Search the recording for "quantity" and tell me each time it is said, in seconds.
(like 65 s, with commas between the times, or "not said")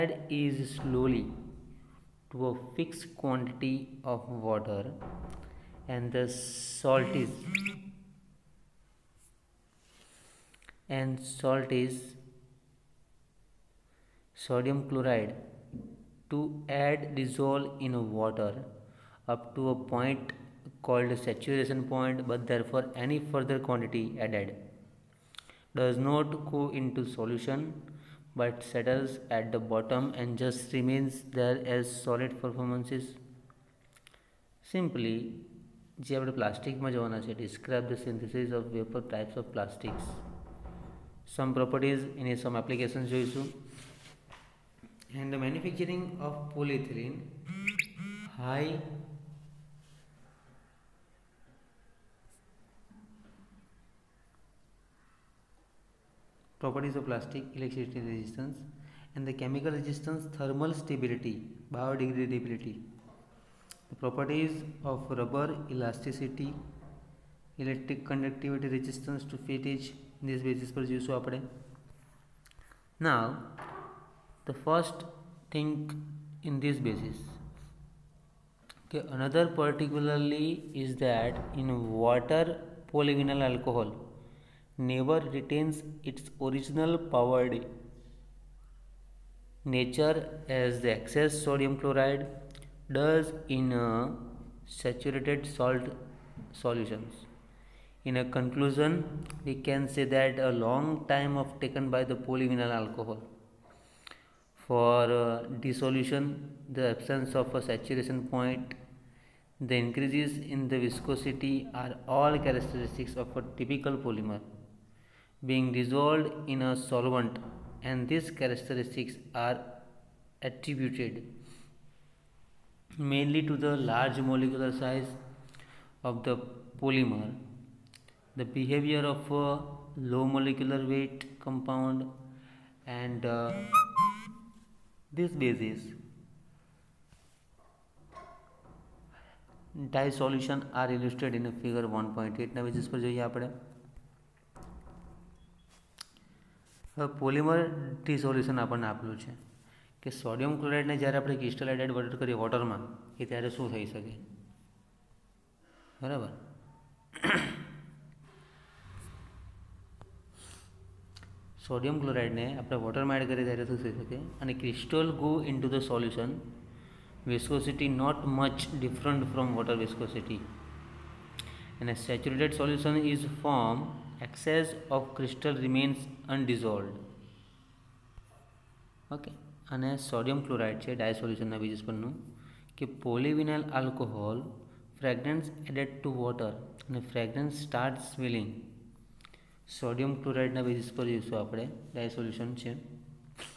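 3 s, 23 s.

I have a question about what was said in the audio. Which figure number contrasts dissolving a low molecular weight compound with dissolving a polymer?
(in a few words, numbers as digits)
1.8.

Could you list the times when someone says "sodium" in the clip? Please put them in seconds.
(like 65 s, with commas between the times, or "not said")
14 s, 91 s.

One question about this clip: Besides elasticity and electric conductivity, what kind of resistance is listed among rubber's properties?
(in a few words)
resistance to fatigue.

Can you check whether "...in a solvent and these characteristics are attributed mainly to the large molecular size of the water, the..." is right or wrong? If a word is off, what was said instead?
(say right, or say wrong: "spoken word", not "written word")
wrong: "polymer", not "water".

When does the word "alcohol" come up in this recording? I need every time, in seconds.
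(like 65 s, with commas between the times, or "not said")
83 s, 102 s.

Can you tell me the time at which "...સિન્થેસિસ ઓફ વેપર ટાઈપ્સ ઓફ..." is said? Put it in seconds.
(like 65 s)
38 s.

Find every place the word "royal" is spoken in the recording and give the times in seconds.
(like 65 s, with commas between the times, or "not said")
not said.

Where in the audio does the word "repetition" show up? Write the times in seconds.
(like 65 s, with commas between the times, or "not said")
not said.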